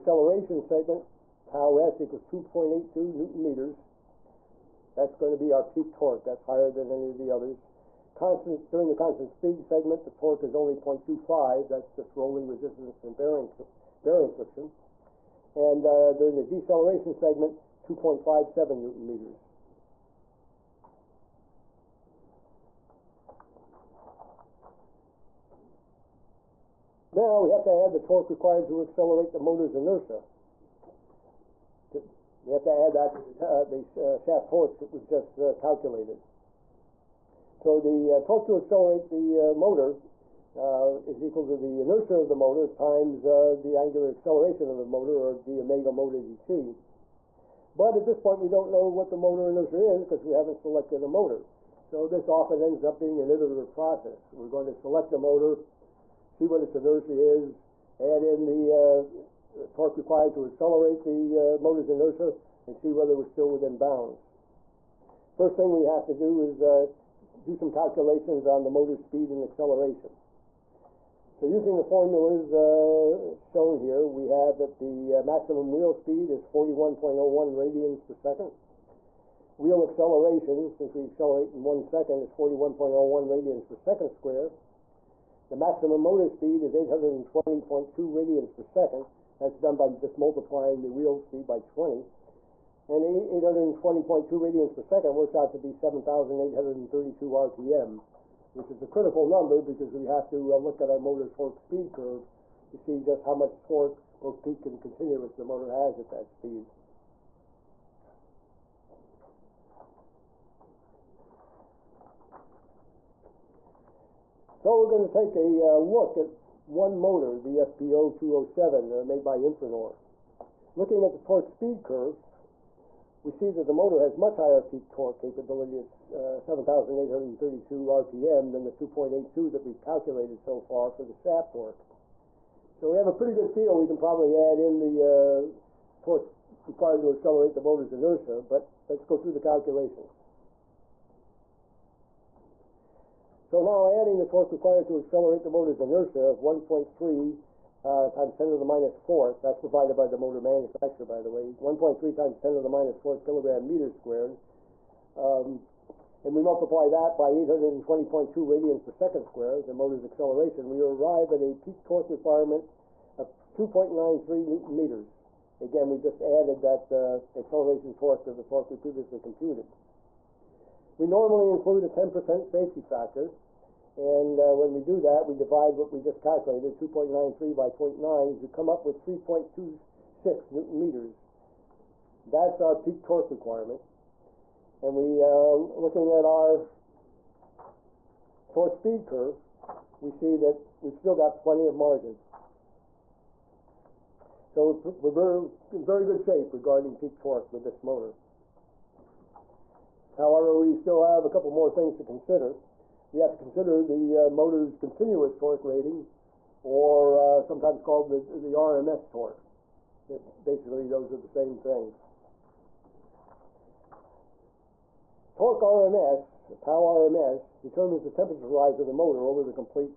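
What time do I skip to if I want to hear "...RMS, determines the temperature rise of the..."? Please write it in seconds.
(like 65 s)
216 s.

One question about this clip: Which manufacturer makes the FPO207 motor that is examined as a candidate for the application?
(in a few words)
Infranor.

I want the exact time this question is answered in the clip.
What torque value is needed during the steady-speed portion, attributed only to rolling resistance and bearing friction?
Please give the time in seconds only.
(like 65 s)
10 s.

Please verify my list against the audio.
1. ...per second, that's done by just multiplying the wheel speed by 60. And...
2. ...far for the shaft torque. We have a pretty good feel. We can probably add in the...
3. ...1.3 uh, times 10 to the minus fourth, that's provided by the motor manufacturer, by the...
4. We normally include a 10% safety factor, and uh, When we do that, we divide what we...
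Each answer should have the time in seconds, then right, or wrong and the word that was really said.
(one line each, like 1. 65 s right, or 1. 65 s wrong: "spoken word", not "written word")
1. 88 s wrong: "20", not "60"
2. 130 s right
3. 146 s right
4. 170 s right.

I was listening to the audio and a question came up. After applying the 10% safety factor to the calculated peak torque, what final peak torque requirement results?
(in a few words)
3.26 newton meters.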